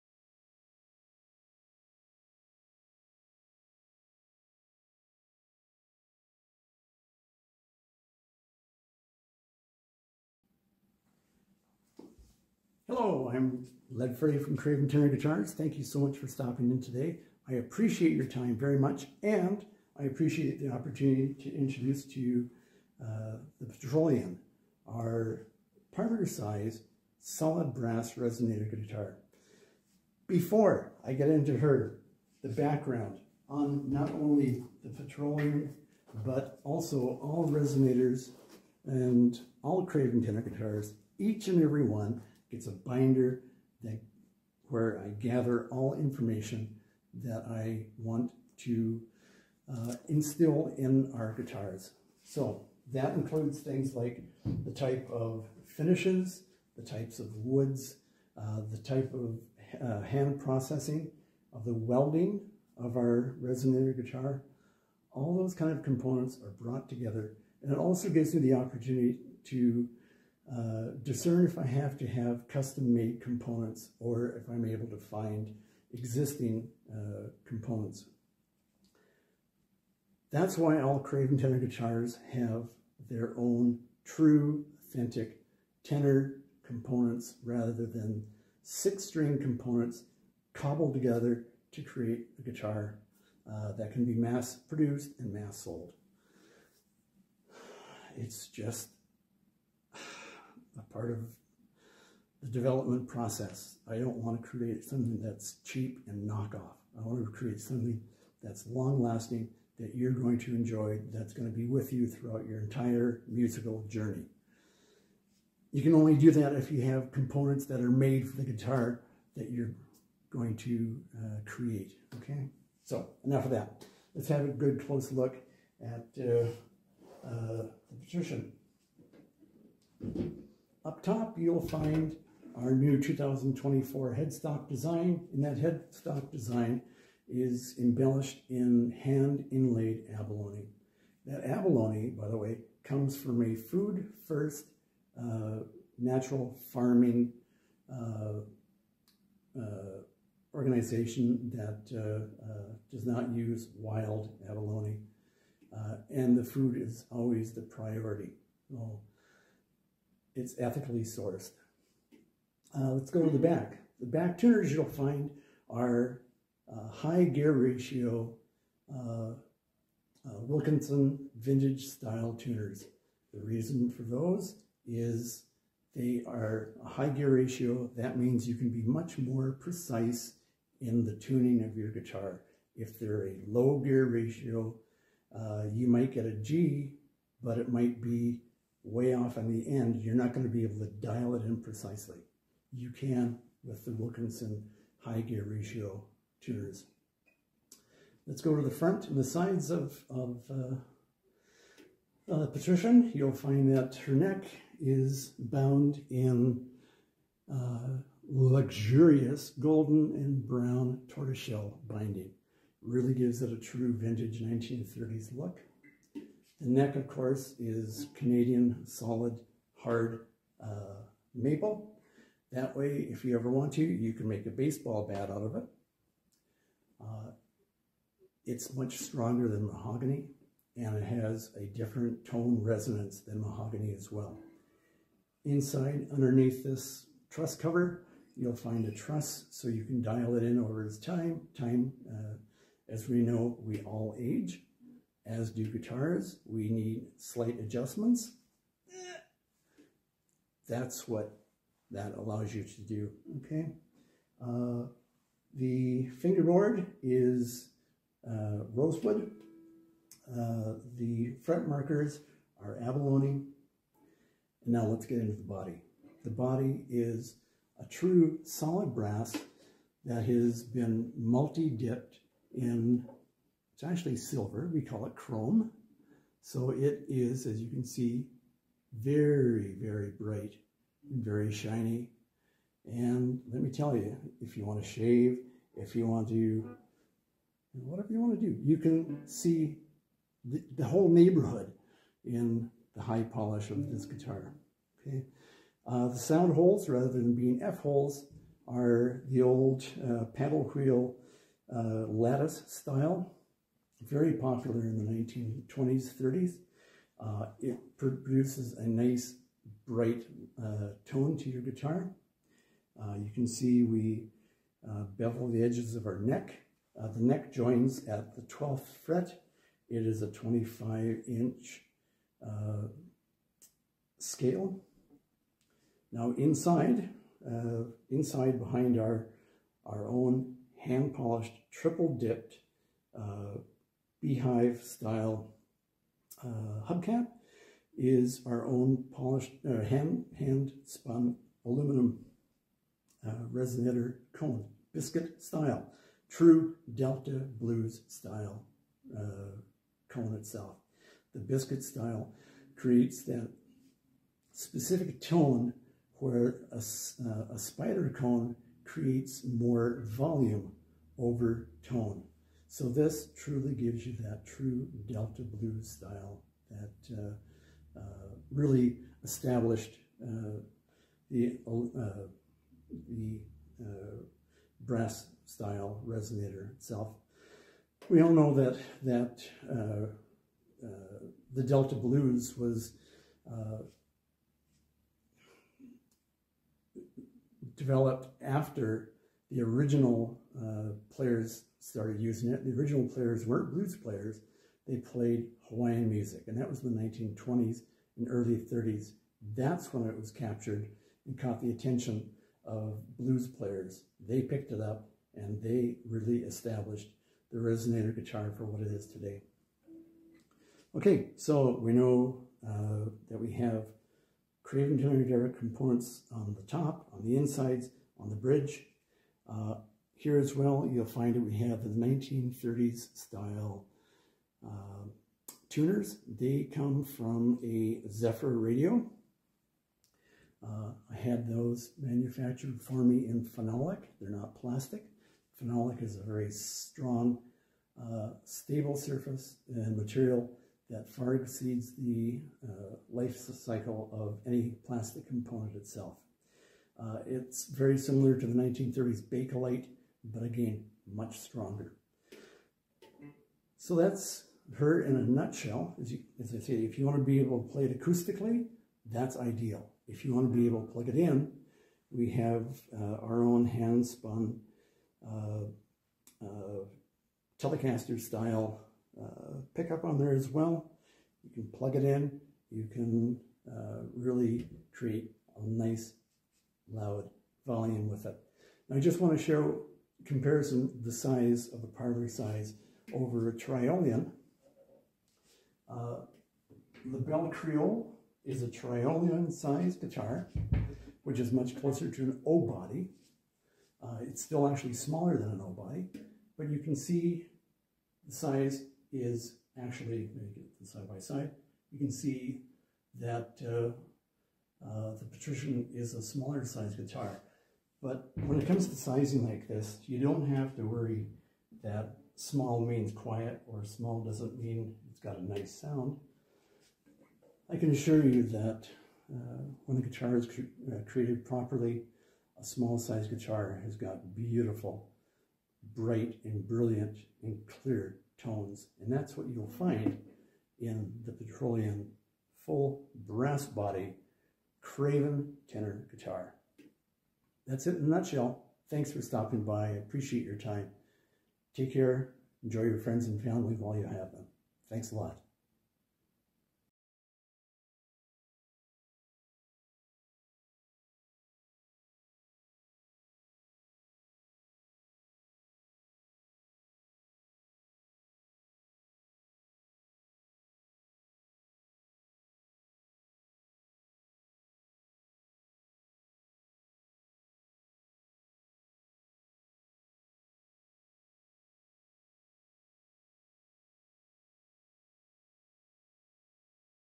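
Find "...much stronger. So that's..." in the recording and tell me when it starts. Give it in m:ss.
7:31.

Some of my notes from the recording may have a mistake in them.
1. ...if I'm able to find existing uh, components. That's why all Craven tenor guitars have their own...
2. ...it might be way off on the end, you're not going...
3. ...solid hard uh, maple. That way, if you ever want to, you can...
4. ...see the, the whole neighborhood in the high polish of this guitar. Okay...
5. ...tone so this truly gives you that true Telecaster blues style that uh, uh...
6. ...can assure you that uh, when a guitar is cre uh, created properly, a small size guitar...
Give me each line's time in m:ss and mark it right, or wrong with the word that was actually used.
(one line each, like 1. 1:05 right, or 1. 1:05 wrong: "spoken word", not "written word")
1. 1:14 right
2. 3:07 right
3. 3:38 right
4. 4:49 right
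5. 6:01 wrong: "Delta", not "Telecaster"
6. 8:37 right.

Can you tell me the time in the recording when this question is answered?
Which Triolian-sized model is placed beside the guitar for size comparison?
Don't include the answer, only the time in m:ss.
8:07.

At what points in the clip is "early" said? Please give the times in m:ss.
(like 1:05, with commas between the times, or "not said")
6:38.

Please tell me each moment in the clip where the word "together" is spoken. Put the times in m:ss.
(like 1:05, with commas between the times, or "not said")
1:06, 1:30.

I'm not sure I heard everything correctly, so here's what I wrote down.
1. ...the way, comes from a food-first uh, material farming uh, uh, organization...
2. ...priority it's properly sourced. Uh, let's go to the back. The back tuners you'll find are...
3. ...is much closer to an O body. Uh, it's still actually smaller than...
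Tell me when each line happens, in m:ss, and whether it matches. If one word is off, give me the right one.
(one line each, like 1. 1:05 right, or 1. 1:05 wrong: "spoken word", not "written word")
1. 2:22 wrong: "natural", not "material"
2. 2:37 wrong: "ethically", not "properly"
3. 8:11 right.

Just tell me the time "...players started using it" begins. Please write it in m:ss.
6:31.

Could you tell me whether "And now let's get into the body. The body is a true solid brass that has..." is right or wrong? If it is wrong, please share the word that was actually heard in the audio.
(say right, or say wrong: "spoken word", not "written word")
right.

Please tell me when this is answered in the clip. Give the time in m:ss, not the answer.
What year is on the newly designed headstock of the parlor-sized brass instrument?
2:13.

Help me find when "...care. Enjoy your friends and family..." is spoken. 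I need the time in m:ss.
9:01.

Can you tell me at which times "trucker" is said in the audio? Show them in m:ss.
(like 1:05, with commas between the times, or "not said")
not said.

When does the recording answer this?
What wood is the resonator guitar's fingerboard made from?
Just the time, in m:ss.
4:18.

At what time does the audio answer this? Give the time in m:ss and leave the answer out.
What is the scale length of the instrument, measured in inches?
5:20.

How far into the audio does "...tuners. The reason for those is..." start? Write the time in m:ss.
2:52.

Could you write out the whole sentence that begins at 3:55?
Inside, underneath this truss cover, you'll find a truss so you can dial it in over time.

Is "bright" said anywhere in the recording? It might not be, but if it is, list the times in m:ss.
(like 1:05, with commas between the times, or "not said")
4:40, 5:09, 8:45.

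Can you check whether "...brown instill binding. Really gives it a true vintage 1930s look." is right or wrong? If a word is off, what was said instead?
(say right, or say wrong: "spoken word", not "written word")
wrong: "tortoiseshell", not "instill".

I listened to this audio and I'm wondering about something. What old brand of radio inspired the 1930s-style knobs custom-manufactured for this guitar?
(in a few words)
Zephyr.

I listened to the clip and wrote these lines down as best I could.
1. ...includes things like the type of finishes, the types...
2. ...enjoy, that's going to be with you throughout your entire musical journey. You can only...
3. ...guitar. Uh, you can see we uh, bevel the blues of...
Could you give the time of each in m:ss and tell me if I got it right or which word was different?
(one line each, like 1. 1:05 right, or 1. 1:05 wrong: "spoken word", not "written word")
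1. 0:53 right
2. 1:50 right
3. 5:11 wrong: "edges", not "blues".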